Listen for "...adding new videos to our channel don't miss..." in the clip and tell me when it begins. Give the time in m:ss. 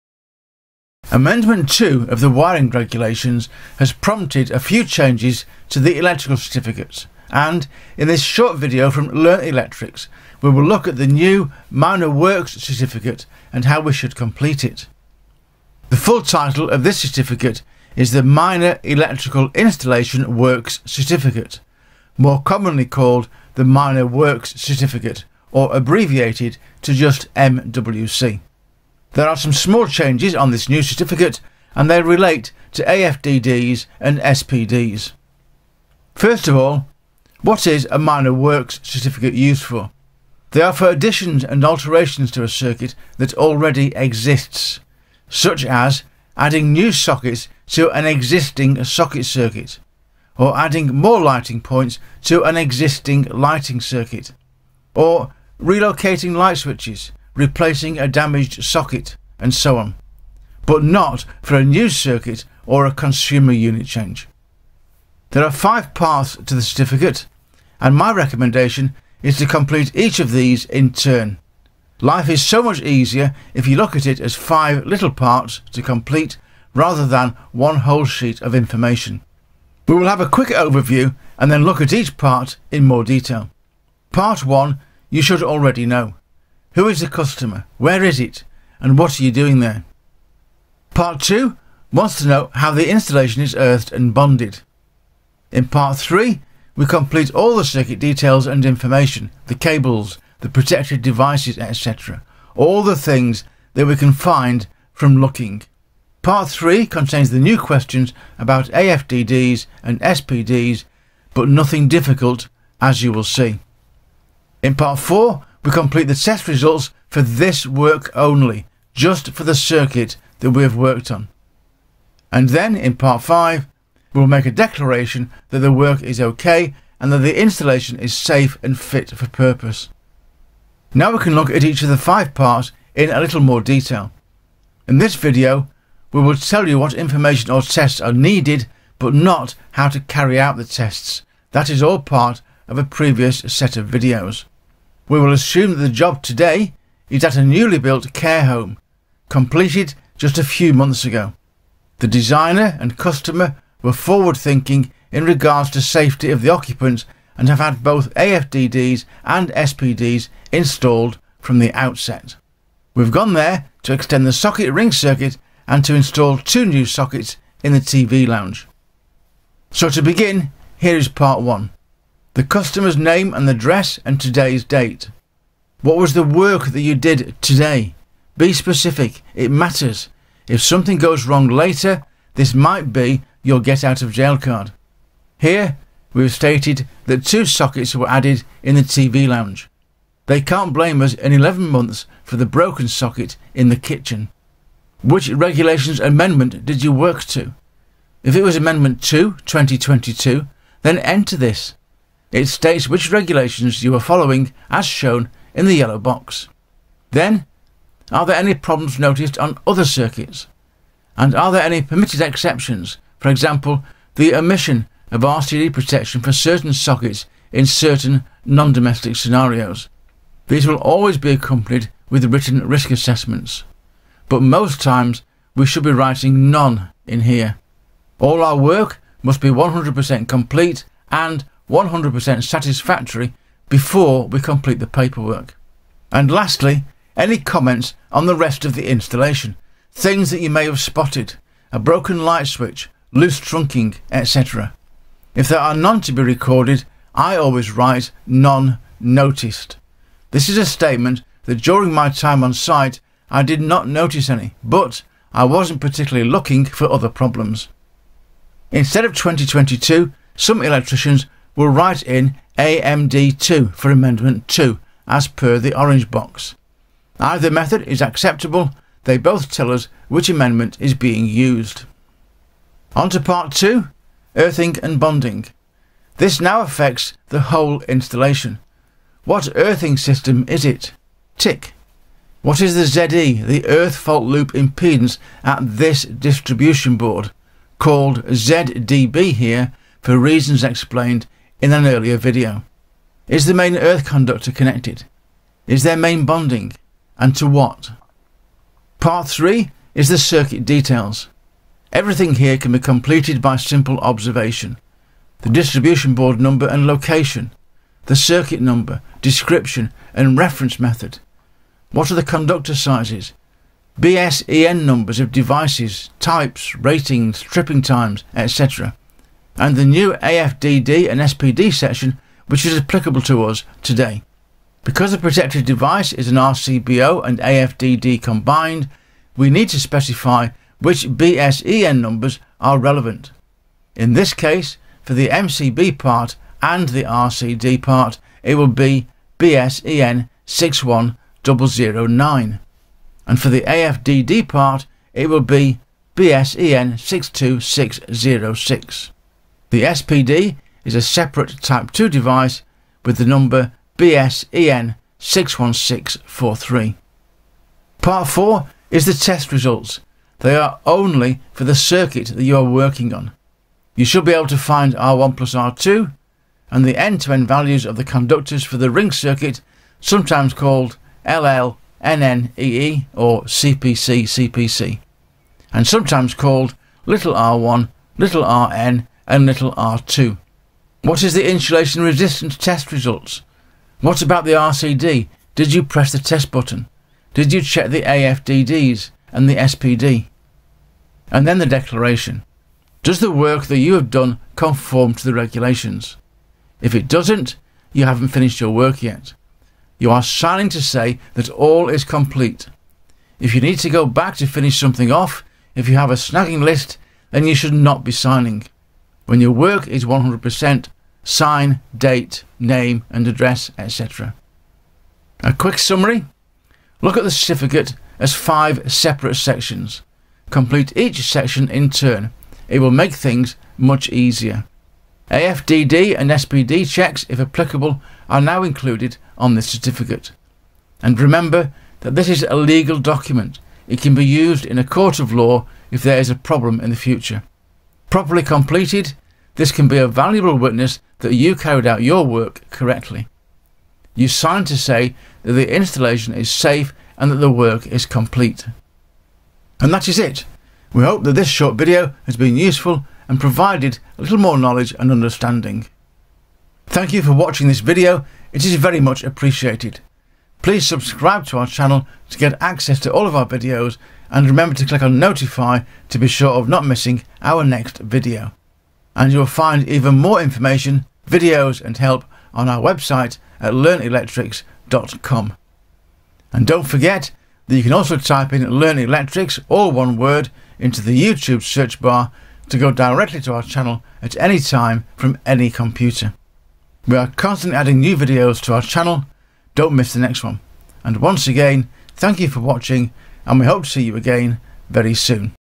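8:07.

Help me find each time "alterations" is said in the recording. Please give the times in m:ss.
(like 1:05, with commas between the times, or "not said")
0:41.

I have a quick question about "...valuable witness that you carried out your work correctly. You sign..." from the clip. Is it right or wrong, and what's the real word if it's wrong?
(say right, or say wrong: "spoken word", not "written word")
right.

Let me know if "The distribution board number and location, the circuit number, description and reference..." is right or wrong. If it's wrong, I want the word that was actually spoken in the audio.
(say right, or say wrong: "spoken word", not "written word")
right.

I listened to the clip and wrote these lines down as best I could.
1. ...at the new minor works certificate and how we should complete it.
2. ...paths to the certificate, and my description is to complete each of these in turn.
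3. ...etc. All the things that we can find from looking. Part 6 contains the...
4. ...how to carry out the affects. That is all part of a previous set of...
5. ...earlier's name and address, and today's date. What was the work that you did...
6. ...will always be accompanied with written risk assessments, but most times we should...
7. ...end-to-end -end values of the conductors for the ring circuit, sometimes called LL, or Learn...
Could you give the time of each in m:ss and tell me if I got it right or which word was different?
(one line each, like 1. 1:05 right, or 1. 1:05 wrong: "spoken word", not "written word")
1. 0:10 right
2. 1:05 wrong: "recommendation", not "description"
3. 1:41 wrong: "3", not "6"
4. 2:19 wrong: "tests", not "affects"
5. 2:52 wrong: "customer", not "earlier"
6. 3:40 right
7. 6:06 wrong: "CPC", not "Learn".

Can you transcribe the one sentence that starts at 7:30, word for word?
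We hope that this short video has been useful and provided a little more knowledge and understanding.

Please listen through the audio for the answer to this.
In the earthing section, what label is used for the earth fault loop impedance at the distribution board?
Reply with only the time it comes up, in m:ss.
4:48.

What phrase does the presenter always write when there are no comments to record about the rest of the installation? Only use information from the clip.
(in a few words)
None noticed.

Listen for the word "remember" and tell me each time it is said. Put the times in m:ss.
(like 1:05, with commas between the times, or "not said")
7:11, 7:44.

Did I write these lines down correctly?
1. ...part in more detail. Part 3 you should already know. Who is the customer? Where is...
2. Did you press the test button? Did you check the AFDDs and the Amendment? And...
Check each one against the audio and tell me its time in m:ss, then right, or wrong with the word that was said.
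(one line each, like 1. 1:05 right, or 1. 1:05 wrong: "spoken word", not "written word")
1. 1:22 wrong: "1", not "3"
2. 6:25 wrong: "SPD", not "Amendment".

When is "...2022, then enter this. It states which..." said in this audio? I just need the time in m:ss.
3:19.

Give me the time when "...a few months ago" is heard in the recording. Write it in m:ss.
2:30.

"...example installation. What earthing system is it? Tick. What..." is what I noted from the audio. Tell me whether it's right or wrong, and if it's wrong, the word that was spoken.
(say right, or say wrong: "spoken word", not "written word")
wrong: "whole", not "example".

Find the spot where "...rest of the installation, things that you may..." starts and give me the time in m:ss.
3:58.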